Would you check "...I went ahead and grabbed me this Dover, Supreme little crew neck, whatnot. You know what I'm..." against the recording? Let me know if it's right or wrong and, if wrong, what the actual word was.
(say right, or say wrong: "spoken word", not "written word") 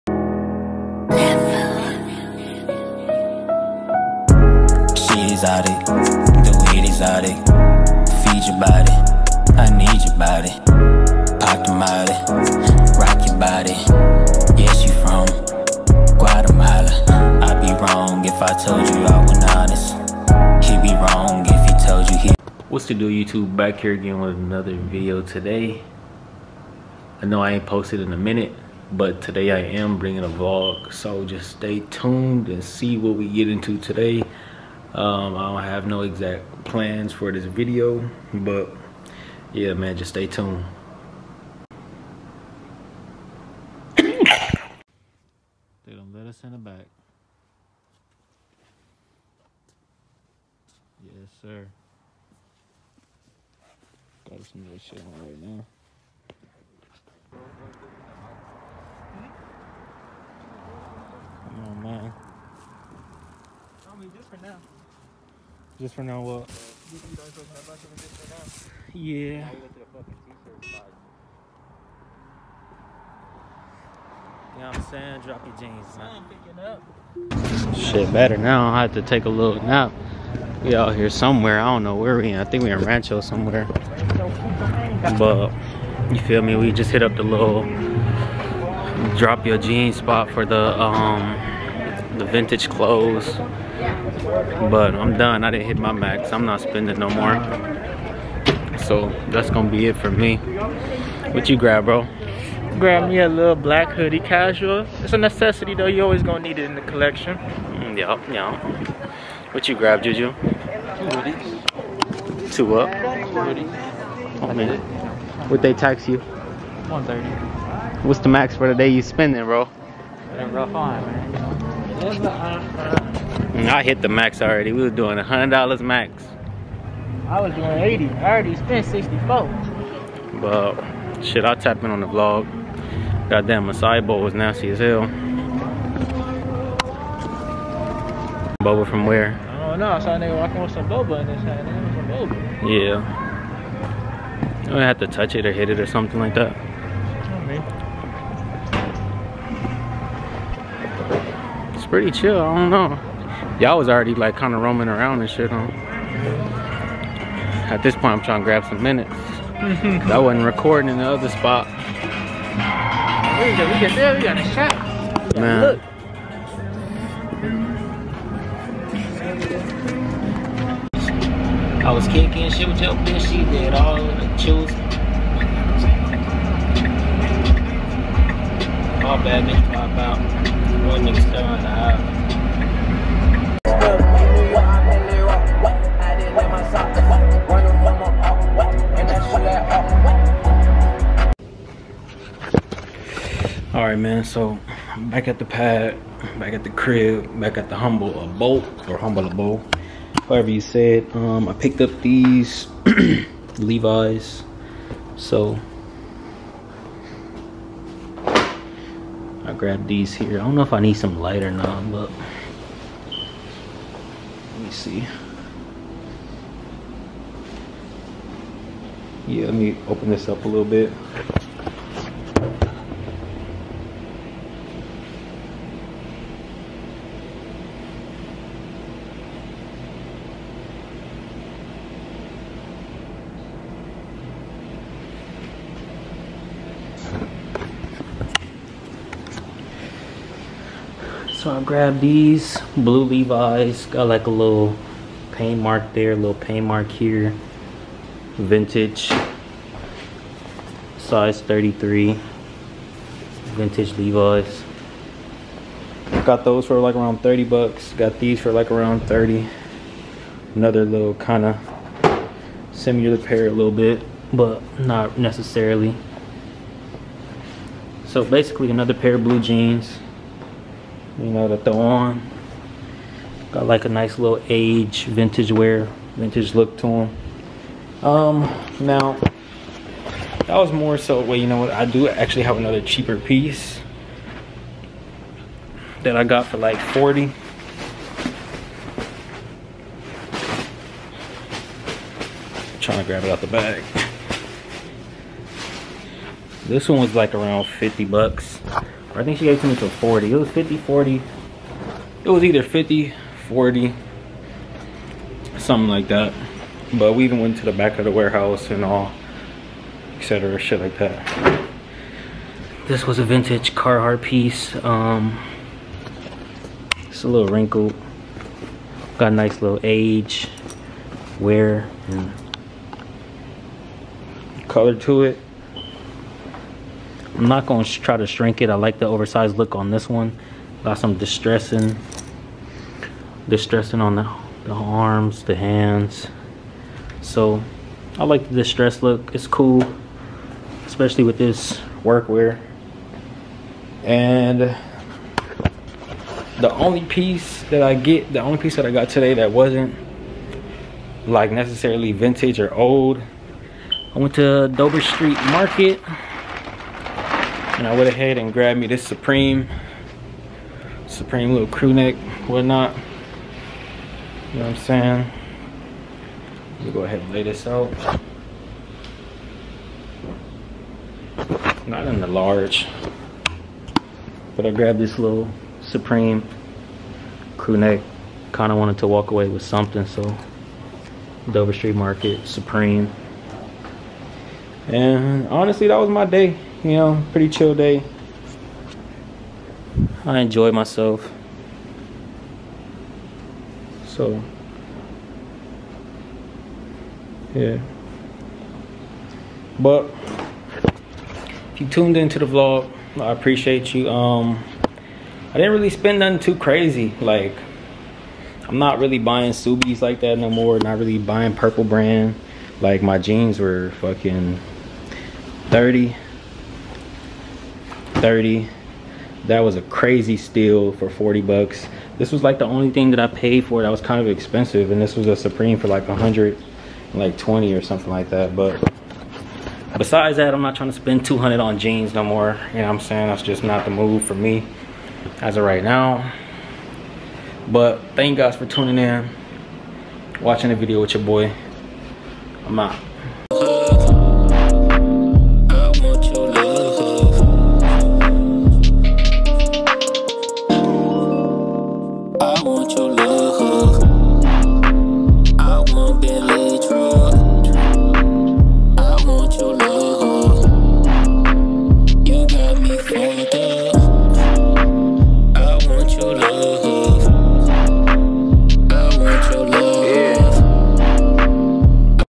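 wrong: "Supreme", not "Dover".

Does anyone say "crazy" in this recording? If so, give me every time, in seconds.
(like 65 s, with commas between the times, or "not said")
406 s, 419 s.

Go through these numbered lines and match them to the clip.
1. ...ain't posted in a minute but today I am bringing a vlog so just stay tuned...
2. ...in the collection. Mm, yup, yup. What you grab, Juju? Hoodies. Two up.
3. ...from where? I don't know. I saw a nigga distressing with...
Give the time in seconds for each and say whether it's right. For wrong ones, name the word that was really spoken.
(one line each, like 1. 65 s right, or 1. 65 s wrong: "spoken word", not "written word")
1. 27 s right
2. 106 s right
3. 138 s wrong: "walking", not "distressing".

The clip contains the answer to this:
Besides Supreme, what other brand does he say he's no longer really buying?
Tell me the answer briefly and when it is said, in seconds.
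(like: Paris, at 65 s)
Purple Brand, at 411 s.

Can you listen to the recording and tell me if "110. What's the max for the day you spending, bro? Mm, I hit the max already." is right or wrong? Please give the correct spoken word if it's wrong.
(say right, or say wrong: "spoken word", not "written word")
wrong: "130", not "110".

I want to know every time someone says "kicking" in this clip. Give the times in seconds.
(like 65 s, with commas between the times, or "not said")
172 s.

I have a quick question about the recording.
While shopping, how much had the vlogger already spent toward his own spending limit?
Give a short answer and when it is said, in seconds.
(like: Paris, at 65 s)
64, at 128 s.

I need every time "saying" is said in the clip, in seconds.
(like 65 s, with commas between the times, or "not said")
74 s, 364 s, 432 s.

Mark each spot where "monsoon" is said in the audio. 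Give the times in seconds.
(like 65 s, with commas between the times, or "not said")
not said.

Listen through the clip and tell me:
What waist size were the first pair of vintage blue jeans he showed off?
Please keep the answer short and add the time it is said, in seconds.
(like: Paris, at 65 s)
33, at 250 s.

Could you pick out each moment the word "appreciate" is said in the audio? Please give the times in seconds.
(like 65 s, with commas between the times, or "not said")
403 s.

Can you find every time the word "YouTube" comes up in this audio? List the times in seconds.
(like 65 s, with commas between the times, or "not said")
23 s.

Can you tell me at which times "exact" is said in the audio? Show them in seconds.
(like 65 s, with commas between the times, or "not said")
36 s.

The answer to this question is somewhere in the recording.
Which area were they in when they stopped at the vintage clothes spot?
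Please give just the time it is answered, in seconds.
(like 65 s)
82 s.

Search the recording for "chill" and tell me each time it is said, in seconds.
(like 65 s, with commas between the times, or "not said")
152 s, 174 s, 387 s.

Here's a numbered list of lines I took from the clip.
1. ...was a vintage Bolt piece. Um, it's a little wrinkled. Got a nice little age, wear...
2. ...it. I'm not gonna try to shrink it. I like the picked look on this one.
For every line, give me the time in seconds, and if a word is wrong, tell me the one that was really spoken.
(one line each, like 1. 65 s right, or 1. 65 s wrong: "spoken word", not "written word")
1. 313 s wrong: "Carhartt", not "Bolt"
2. 325 s wrong: "oversized", not "picked".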